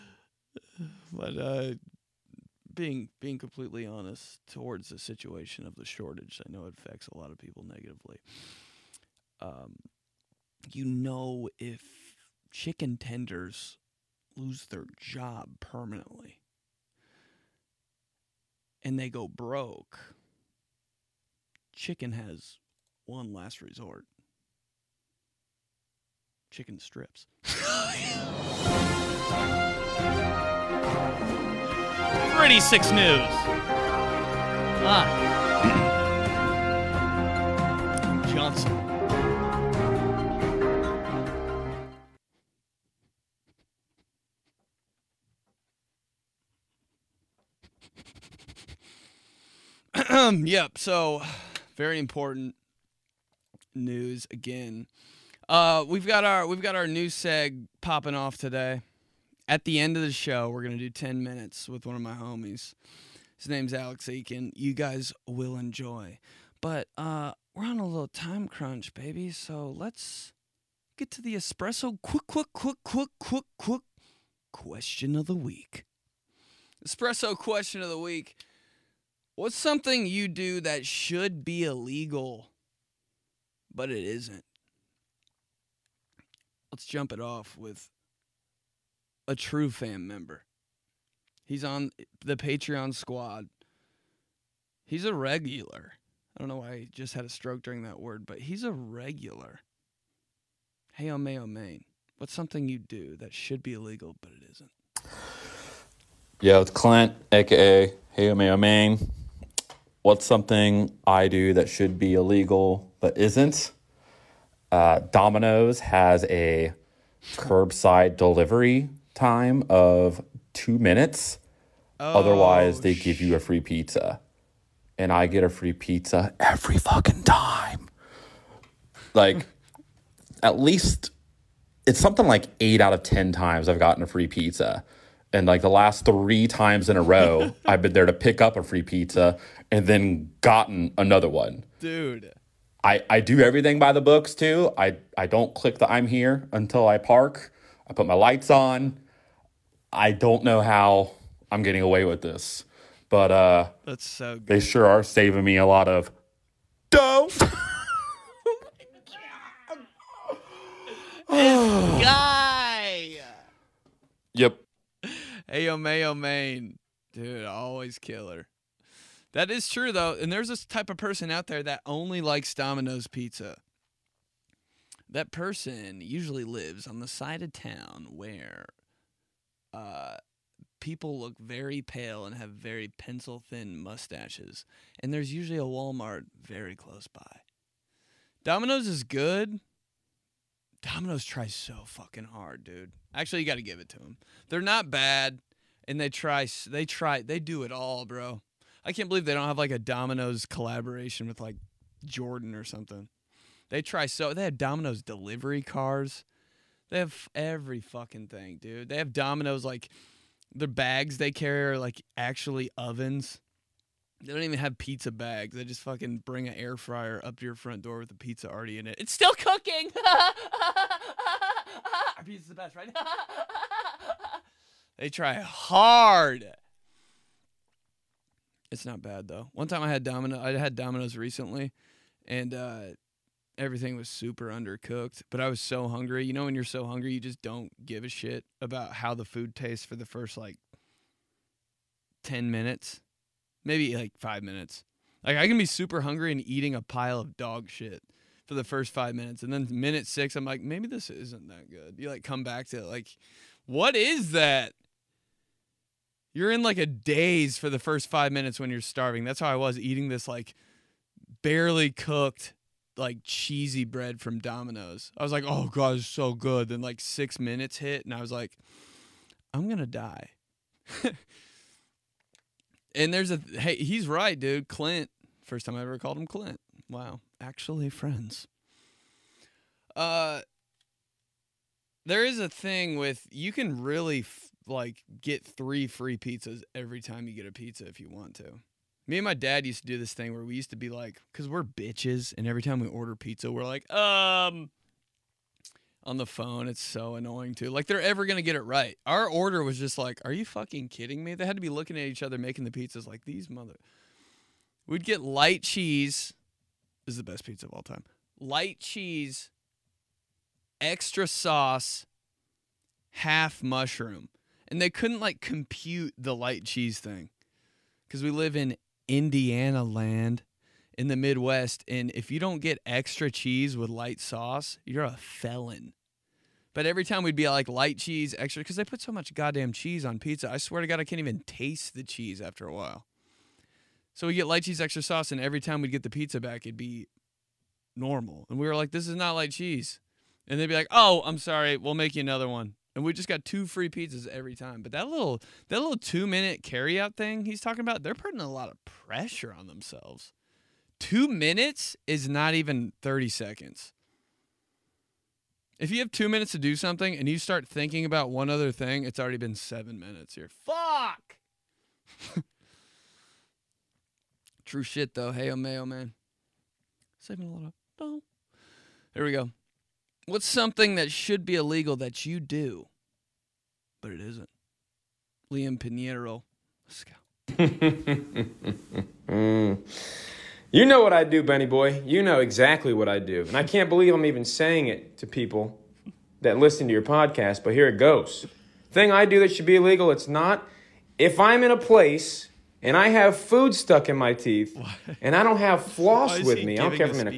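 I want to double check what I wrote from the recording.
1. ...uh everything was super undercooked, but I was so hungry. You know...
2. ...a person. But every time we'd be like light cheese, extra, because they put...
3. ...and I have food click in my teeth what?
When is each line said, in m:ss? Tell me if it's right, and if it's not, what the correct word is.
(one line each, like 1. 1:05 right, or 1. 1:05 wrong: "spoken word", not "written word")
1. 3:52 right
2. 5:25 wrong: "felon", not "person"
3. 6:32 wrong: "stuck", not "click".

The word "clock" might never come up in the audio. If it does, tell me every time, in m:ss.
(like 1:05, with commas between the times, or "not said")
not said.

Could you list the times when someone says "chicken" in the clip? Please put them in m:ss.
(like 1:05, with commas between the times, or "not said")
0:12, 0:21, 0:26.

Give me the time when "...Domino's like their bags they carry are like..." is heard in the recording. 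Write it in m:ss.
3:29.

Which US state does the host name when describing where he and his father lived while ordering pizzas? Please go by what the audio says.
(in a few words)
Indiana.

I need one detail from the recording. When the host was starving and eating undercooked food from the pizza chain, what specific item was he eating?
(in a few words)
cheesy bread.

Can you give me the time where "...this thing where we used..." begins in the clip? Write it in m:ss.
4:49.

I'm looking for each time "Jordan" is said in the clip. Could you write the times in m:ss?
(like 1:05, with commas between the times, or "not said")
3:22.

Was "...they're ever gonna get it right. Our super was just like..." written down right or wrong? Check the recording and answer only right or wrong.
wrong.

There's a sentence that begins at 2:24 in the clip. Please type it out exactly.
I, I don't click the I'm here until I park.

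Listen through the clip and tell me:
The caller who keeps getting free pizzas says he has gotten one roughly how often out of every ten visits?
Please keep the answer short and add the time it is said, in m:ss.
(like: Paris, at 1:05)
8 out of 10, at 2:12.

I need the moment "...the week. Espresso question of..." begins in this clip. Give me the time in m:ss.
1:15.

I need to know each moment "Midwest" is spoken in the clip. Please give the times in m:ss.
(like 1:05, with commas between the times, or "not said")
5:21.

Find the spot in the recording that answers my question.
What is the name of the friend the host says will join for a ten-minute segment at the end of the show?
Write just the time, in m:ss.
1:03.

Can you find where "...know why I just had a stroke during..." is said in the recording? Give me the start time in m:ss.
1:36.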